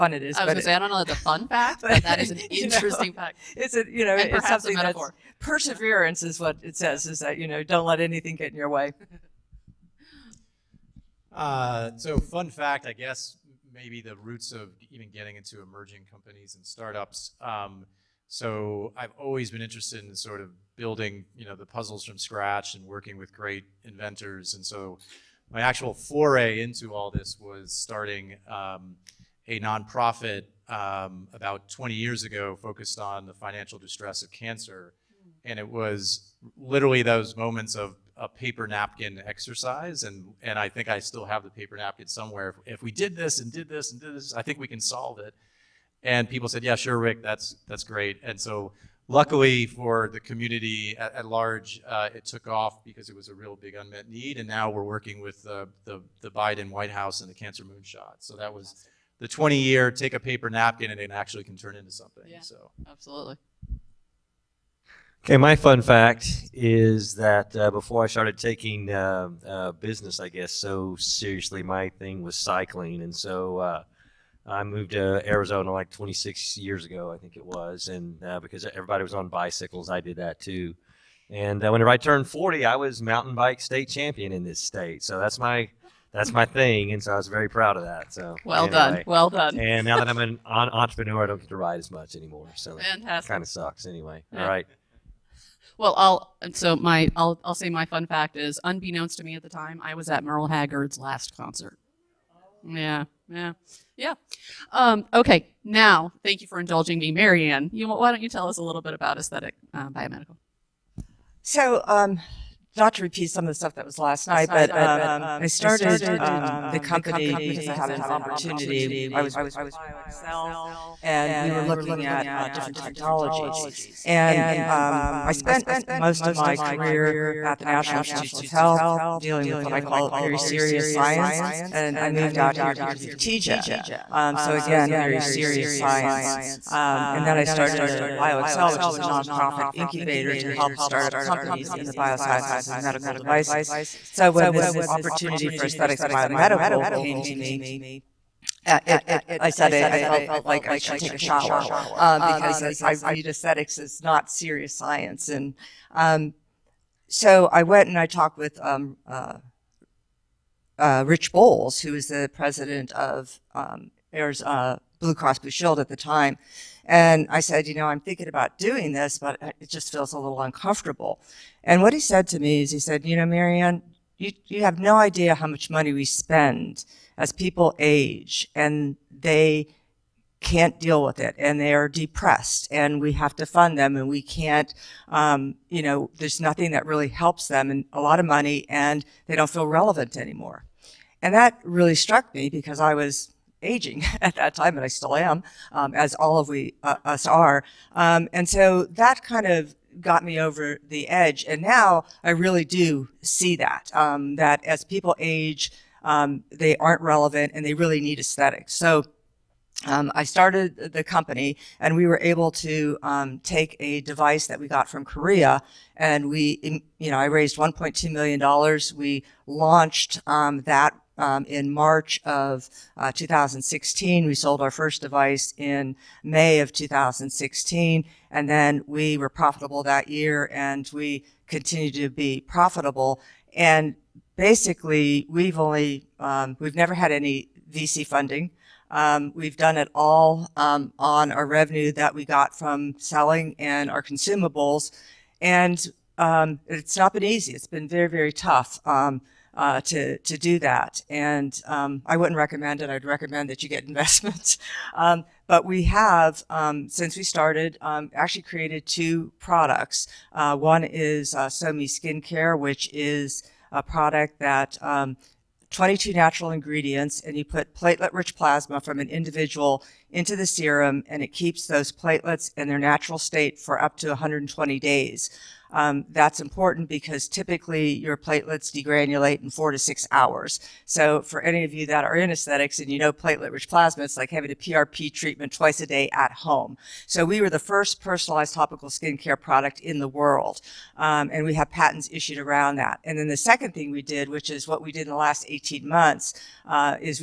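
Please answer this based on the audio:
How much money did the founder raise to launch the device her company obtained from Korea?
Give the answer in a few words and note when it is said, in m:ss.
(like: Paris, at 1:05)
$1.2 million, at 3:37.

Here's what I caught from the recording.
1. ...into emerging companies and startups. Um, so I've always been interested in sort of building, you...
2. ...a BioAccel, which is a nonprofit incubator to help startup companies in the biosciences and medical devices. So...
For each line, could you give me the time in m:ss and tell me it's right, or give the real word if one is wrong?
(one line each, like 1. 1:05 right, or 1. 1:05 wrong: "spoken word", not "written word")
1. 0:15 right
2. 2:17 right.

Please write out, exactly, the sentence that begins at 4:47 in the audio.
So we were the first personalized topical skincare product in the world, um, and we have patents issued around that.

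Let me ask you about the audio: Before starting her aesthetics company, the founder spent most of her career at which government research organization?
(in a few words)
National Institutes of Health.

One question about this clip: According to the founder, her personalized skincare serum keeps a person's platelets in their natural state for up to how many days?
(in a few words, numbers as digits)
120 days.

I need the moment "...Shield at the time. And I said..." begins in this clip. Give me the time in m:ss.
2:45.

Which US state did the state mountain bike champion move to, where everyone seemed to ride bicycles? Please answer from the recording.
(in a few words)
Arizona.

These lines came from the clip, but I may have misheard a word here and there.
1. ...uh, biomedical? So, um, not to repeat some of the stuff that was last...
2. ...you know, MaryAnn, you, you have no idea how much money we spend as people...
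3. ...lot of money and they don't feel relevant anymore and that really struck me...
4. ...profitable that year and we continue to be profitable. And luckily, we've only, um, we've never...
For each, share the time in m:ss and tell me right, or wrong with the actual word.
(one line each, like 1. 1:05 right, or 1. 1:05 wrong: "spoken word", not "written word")
1. 1:49 right
2. 2:53 right
3. 3:07 right
4. 3:49 wrong: "basically", not "luckily".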